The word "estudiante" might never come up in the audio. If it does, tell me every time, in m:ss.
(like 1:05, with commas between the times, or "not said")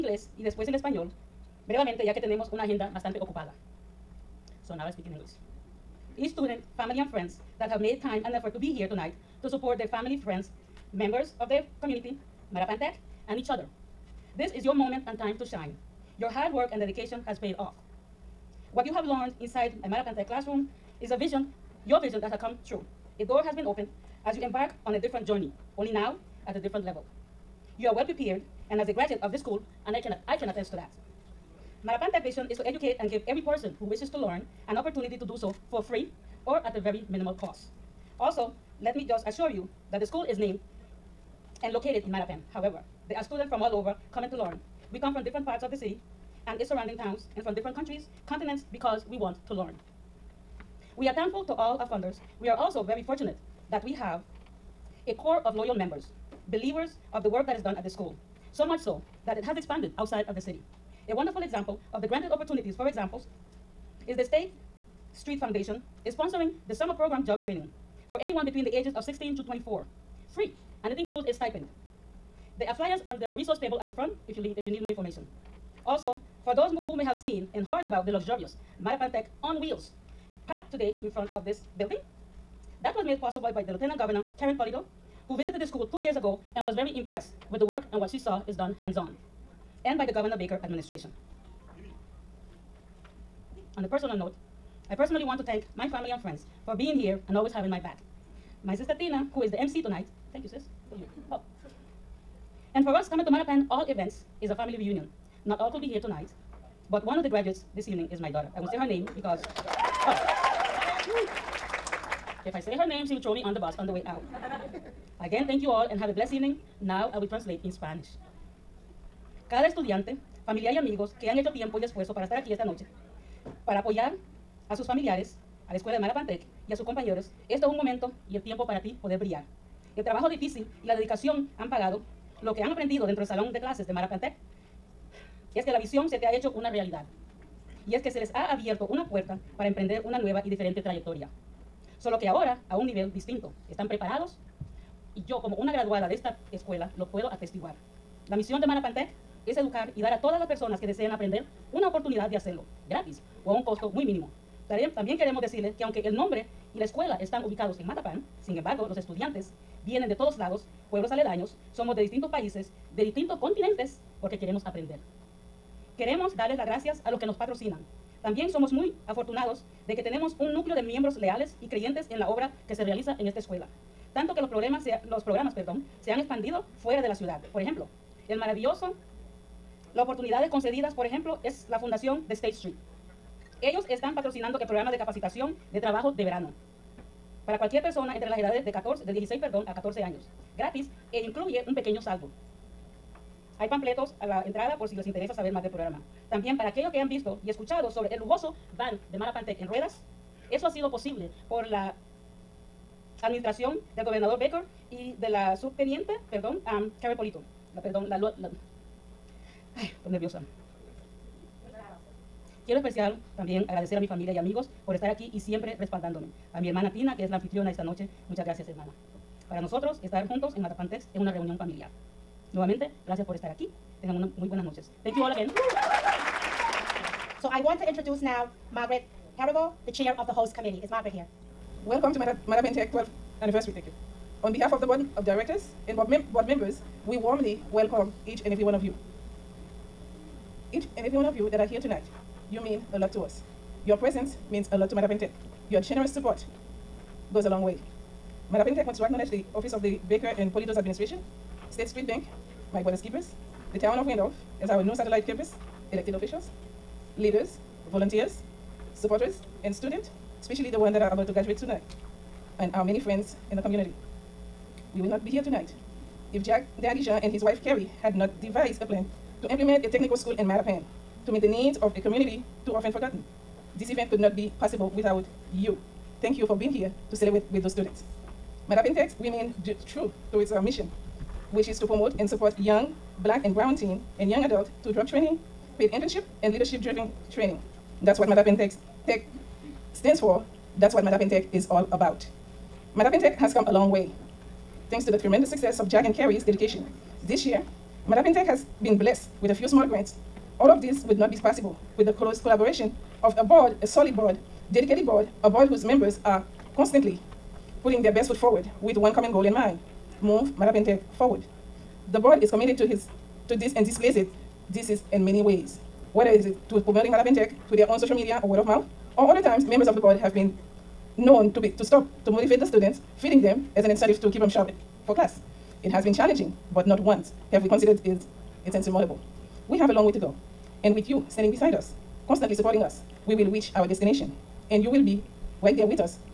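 1:59, 2:38.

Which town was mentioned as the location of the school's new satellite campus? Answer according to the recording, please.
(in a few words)
Randolph.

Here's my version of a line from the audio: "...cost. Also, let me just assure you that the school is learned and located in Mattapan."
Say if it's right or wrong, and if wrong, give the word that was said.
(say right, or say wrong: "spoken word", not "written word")
wrong: "named", not "learned".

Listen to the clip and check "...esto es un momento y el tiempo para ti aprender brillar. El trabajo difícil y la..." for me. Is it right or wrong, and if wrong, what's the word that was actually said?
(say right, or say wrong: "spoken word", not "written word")
wrong: "poder", not "aprender".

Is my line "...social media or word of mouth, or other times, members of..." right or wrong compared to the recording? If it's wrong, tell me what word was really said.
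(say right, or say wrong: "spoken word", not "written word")
right.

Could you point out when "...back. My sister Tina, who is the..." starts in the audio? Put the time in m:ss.
1:37.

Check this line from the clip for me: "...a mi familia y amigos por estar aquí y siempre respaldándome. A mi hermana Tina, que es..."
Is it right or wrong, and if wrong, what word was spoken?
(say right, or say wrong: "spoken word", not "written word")
right.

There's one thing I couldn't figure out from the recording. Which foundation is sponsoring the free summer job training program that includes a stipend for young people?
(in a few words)
State Street Foundation.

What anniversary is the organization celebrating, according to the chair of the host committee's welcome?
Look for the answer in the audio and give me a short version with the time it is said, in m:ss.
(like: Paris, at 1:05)
12th, at 3:52.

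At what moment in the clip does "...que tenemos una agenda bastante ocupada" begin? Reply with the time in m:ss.
0:02.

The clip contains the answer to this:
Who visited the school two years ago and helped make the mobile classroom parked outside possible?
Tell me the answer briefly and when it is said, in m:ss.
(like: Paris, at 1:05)
Karyn Polito, at 1:24.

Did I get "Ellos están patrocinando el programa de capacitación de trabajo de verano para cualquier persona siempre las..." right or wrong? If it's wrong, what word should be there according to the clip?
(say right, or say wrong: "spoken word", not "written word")
wrong: "entre", not "siempre".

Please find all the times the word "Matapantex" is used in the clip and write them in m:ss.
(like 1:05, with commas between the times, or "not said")
3:40.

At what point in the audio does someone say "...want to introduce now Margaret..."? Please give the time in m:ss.
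3:47.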